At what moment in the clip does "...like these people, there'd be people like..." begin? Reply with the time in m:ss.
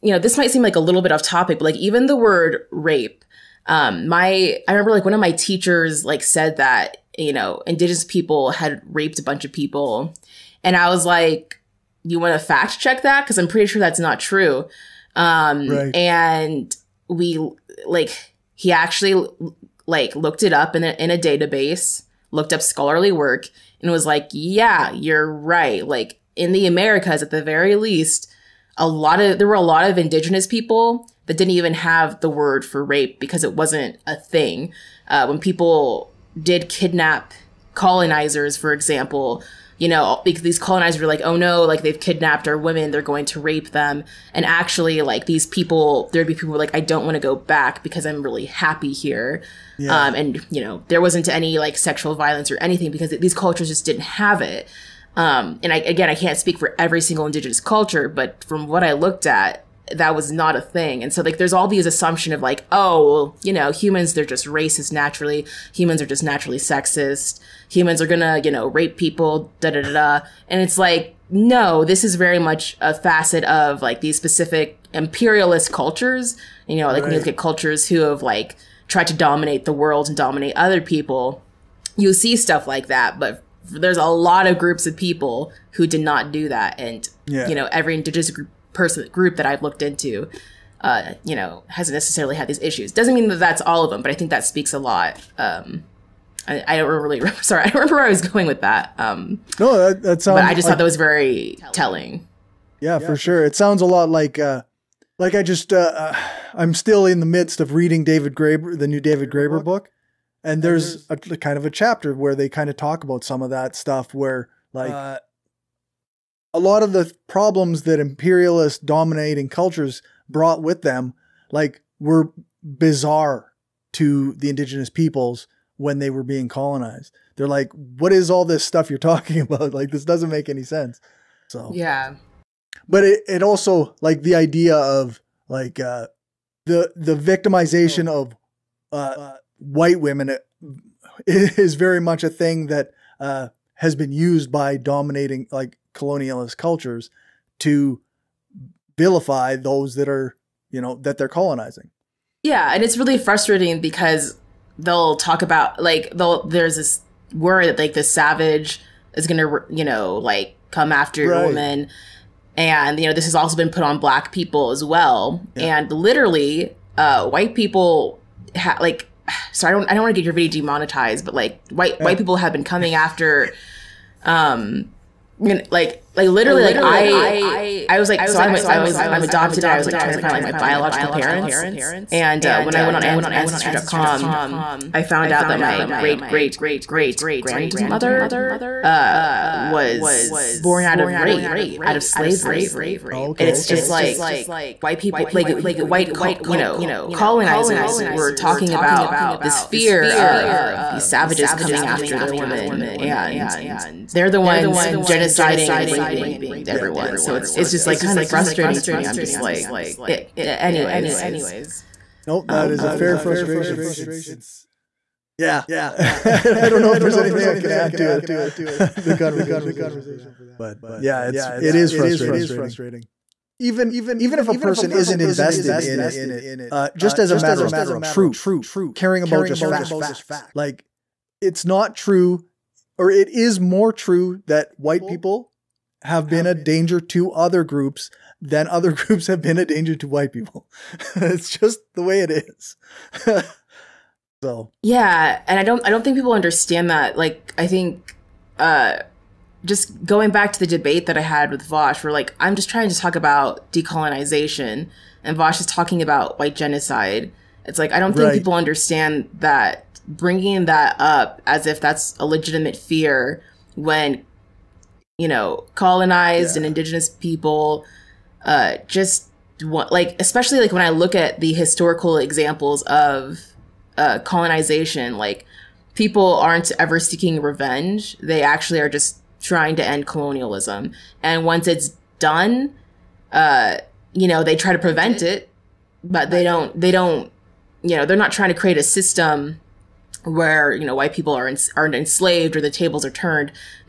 0:45.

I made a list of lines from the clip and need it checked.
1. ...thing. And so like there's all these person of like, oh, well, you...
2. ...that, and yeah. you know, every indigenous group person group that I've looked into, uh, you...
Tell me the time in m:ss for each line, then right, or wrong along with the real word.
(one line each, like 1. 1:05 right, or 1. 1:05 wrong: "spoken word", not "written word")
1. 1:00 wrong: "assumption", not "person"
2. 1:26 right.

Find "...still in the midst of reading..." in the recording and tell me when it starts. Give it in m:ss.
1:46.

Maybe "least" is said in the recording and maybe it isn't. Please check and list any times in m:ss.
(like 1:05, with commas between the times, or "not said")
0:27.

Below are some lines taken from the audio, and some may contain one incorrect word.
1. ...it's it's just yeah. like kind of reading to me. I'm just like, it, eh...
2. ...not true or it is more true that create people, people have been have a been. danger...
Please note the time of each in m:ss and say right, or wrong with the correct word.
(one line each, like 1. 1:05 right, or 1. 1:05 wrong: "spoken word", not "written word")
1. 3:27 wrong: "frustrating", not "reading"
2. 3:51 wrong: "white", not "create".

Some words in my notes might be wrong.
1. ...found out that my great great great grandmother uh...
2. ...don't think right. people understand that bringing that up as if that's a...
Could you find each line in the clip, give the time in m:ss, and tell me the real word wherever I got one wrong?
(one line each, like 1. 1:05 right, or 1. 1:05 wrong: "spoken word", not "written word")
1. 3:05 right
2. 4:18 right.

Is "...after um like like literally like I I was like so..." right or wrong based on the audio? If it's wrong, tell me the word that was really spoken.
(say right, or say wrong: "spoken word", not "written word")
right.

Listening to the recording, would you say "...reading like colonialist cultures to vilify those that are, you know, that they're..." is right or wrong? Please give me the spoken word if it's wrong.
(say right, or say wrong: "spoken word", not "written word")
wrong: "dominating", not "reading".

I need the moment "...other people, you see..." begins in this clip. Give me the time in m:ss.
1:20.